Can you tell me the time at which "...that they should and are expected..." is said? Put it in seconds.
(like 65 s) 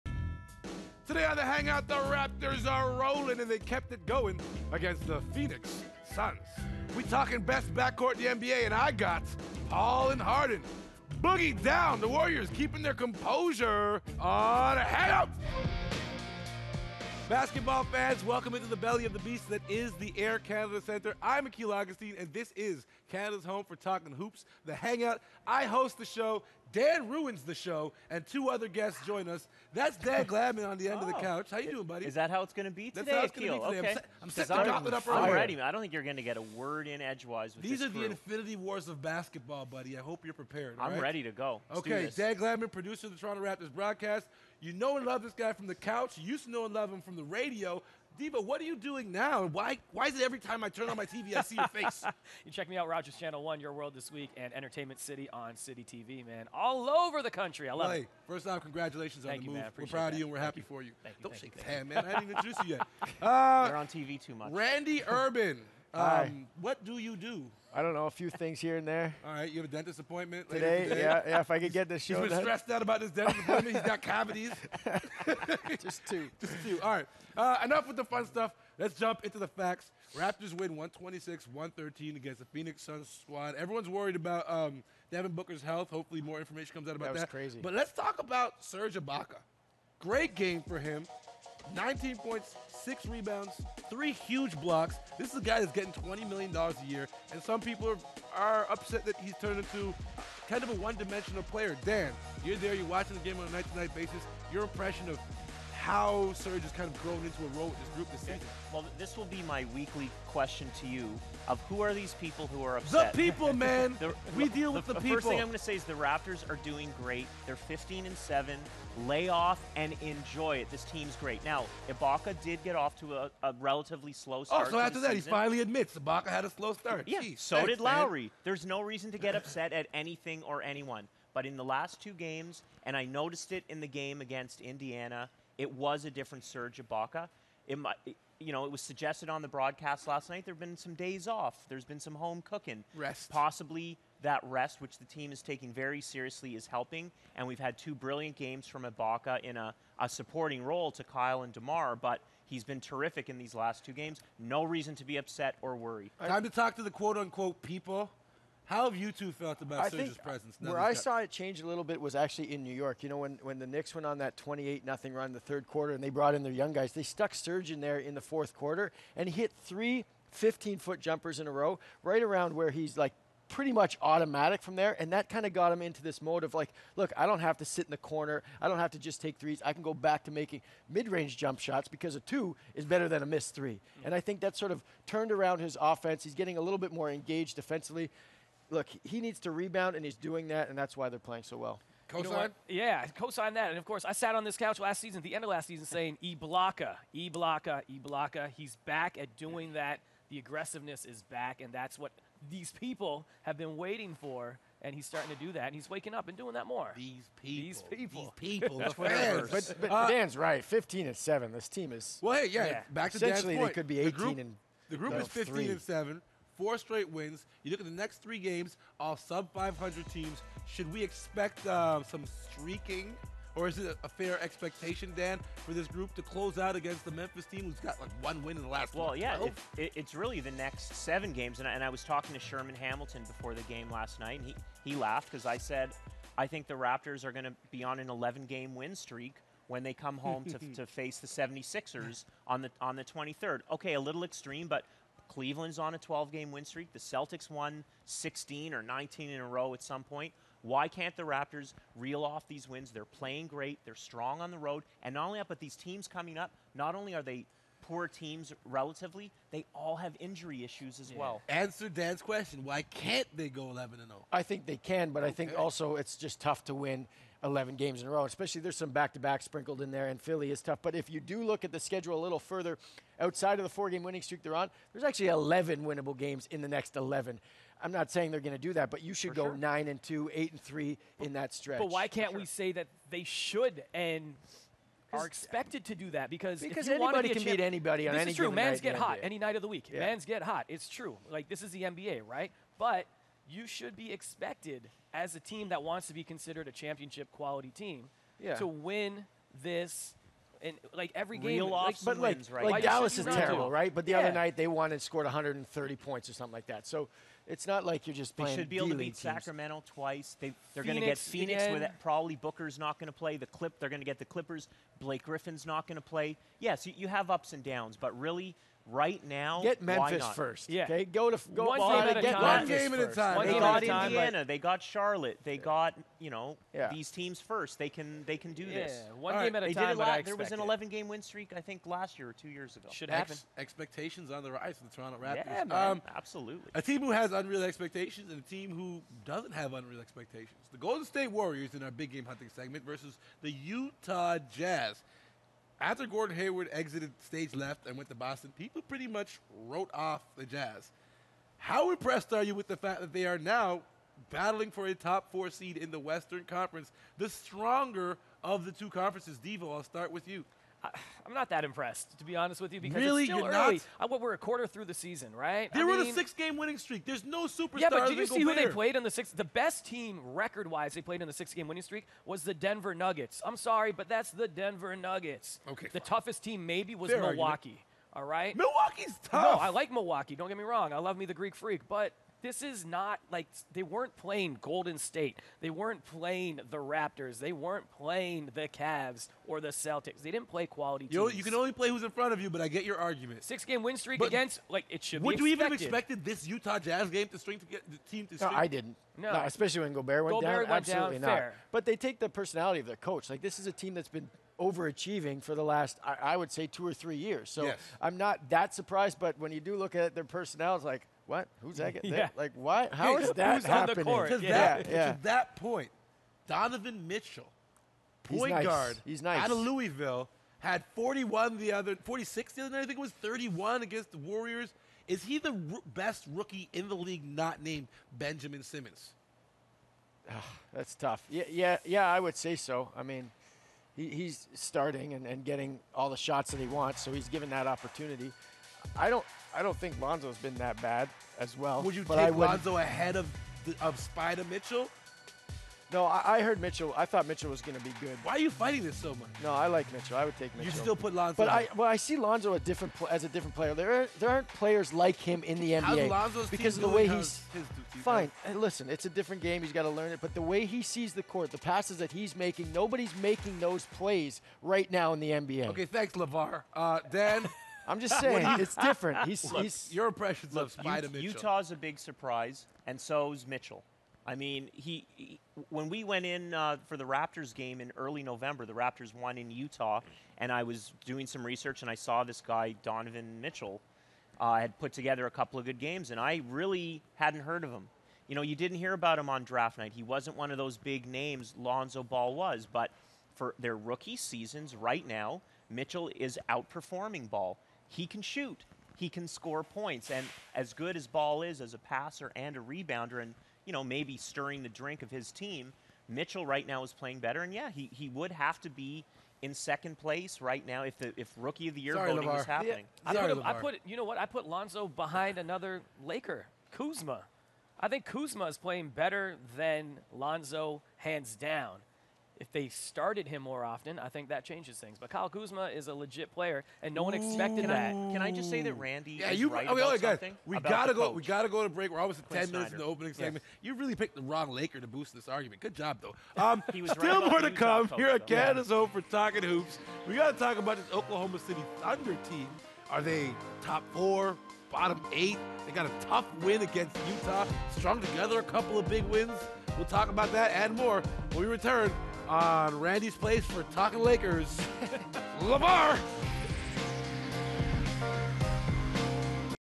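282 s.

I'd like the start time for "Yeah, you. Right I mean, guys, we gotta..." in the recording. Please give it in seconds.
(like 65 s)
529 s.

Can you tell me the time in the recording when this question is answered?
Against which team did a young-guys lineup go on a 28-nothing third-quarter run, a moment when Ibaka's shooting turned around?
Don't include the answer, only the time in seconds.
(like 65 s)
162 s.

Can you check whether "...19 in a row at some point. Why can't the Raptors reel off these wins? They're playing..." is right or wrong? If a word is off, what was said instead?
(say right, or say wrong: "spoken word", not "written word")
right.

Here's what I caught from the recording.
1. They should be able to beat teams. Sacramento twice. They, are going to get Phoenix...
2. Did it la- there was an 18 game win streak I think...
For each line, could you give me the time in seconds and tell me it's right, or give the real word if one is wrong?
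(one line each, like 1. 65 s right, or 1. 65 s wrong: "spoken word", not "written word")
1. 308 s right
2. 329 s wrong: "11", not "18".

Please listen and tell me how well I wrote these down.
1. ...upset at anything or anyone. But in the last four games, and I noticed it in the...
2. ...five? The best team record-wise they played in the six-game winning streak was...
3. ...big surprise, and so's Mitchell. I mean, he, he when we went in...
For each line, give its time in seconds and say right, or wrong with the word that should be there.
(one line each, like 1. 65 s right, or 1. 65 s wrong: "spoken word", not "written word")
1. 129 s wrong: "two", not "four"
2. 369 s wrong: "six", not "five"
3. 471 s right.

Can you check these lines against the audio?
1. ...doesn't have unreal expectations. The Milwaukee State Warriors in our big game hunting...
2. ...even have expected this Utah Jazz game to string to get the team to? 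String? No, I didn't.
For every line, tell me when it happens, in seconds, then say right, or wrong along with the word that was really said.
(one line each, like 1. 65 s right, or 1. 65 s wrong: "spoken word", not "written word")
1. 339 s wrong: "Golden", not "Milwaukee"
2. 395 s right.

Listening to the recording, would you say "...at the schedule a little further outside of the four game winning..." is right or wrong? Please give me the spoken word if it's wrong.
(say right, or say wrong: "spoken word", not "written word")
right.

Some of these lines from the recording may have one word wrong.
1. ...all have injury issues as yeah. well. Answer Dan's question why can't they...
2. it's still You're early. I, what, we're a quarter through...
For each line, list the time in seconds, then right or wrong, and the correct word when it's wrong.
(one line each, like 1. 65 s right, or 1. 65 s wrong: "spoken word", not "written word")
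1. 259 s right
2. 363 s right.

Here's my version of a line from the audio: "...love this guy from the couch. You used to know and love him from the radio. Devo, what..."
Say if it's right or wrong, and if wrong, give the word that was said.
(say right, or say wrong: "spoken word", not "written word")
right.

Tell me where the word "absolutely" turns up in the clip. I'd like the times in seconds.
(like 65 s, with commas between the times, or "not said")
336 s, 400 s.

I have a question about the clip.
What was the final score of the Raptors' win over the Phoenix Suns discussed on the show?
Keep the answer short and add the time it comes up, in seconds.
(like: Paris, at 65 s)
126-113, at 80 s.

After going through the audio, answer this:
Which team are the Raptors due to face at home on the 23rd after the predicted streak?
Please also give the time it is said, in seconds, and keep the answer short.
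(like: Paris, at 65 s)
76ers, at 241 s.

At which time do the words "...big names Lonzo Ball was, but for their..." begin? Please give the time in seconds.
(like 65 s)
490 s.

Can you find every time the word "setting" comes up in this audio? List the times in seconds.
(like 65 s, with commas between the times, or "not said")
34 s.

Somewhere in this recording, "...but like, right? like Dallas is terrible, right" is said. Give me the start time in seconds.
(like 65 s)
302 s.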